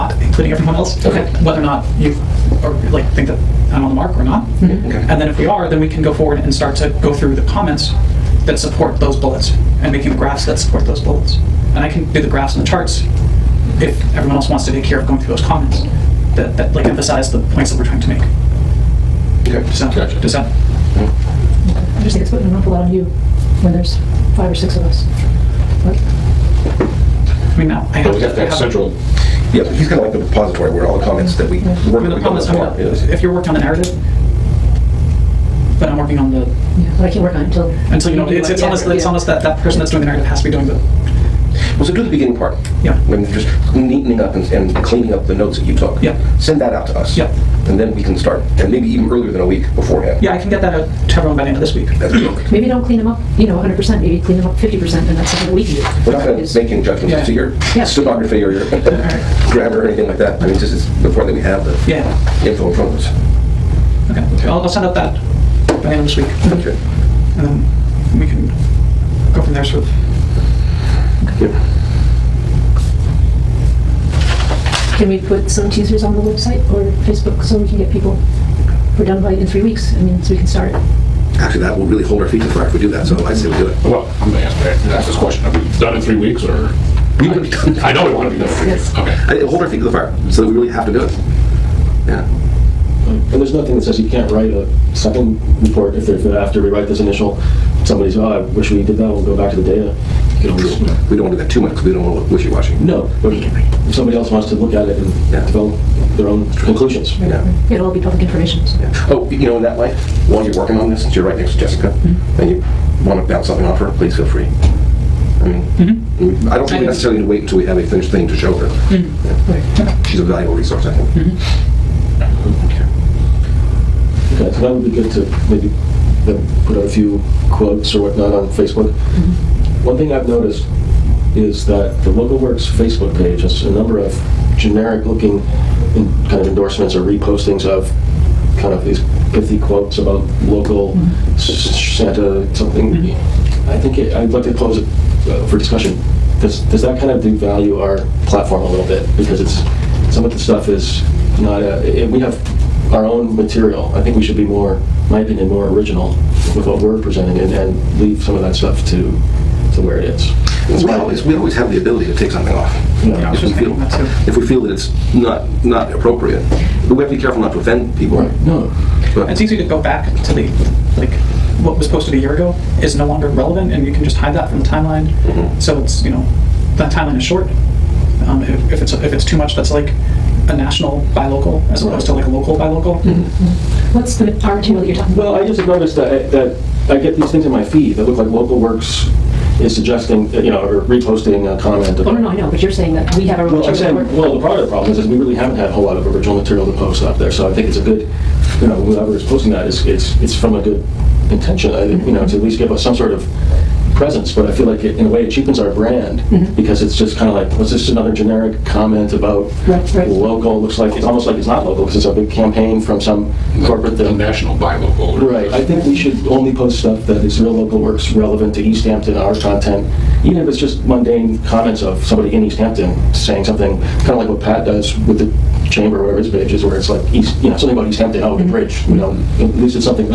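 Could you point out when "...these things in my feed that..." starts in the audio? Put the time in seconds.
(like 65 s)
187 s.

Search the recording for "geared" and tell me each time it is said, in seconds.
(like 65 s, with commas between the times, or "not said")
not said.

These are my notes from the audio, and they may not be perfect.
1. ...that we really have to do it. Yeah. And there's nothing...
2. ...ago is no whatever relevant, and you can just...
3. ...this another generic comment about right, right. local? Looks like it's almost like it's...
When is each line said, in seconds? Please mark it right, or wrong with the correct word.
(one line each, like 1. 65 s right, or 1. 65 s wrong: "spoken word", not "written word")
1. 90 s right
2. 172 s wrong: "longer", not "whatever"
3. 207 s right.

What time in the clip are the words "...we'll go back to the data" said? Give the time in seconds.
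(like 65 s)
99 s.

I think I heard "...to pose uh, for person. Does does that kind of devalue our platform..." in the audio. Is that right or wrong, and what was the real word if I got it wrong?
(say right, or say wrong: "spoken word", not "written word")
wrong: "discussion", not "person".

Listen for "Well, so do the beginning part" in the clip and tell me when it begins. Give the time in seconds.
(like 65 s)
41 s.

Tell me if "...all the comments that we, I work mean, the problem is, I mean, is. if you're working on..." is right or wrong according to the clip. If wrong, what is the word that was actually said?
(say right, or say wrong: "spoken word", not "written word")
right.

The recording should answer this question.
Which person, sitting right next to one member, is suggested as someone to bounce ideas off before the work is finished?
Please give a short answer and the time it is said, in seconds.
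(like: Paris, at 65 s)
Jessica, at 111 s.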